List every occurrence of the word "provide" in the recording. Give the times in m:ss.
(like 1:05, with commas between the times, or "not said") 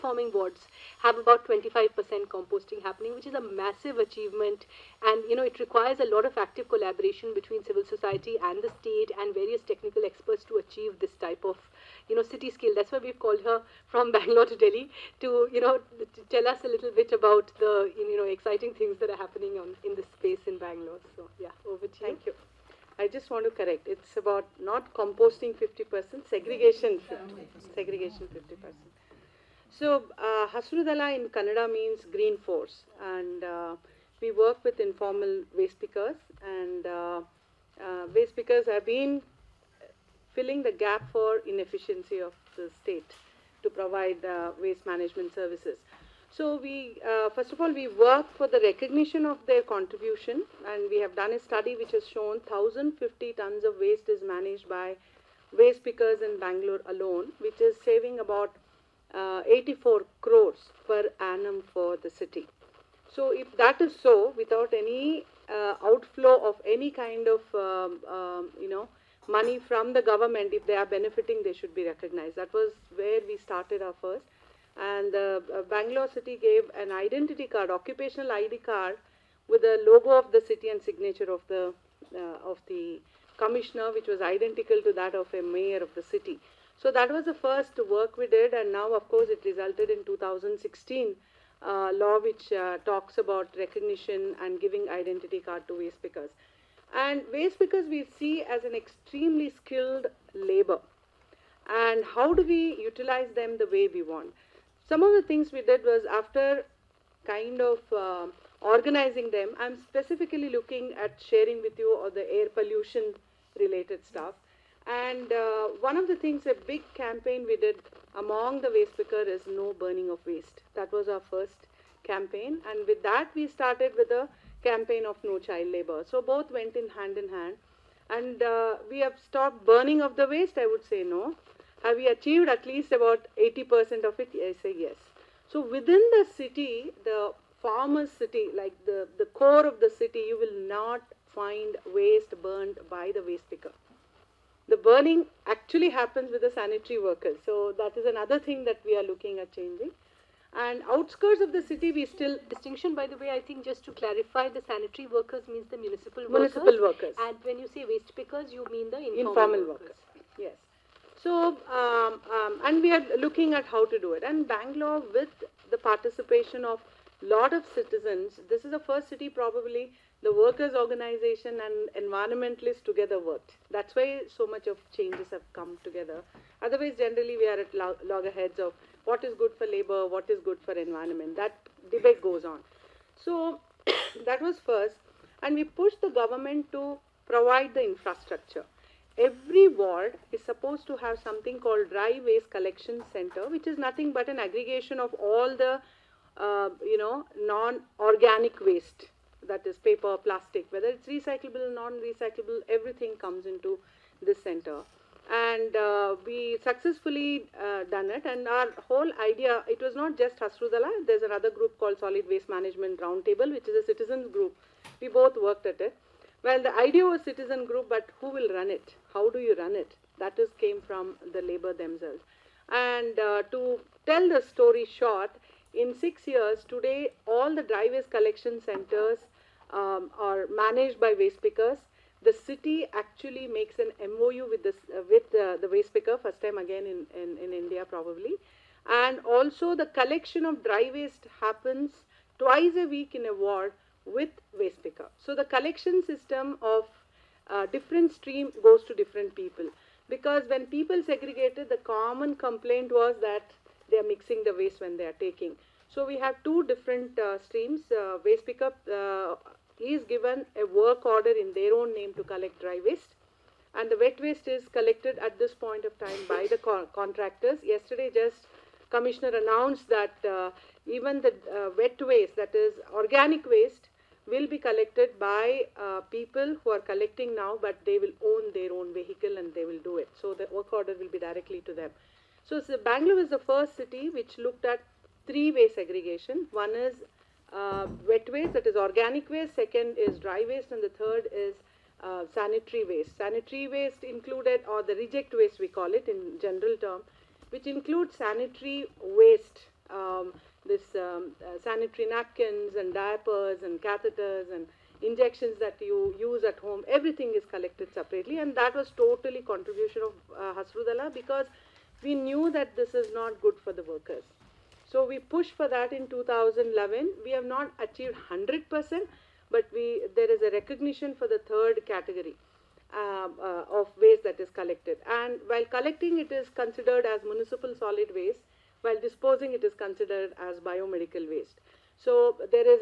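0:43, 3:07.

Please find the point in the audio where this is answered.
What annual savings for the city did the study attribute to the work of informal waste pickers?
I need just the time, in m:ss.
0:59.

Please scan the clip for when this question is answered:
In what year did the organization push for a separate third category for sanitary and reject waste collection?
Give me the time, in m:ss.
5:16.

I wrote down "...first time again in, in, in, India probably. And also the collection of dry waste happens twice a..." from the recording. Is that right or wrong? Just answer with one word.
right.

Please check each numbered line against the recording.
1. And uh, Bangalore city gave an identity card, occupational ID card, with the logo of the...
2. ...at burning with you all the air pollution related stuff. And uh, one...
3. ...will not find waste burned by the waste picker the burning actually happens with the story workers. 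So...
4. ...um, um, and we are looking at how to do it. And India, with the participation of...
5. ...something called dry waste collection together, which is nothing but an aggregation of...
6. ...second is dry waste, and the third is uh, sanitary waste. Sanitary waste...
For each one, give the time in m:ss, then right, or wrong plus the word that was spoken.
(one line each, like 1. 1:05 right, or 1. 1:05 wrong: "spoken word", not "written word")
1. 1:14 right
2. 1:51 wrong: "sharing", not "burning"
3. 2:20 wrong: "sanitary", not "story"
4. 2:41 wrong: "Bangalore", not "India"
5. 3:11 wrong: "center", not "together"
6. 4:49 right.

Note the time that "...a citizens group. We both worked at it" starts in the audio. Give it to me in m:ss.
3:33.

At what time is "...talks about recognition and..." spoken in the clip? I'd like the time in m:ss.
1:32.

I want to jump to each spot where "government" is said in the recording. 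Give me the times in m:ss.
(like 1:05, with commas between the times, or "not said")
1:10, 3:06.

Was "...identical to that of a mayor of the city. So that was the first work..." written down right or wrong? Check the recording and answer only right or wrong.
right.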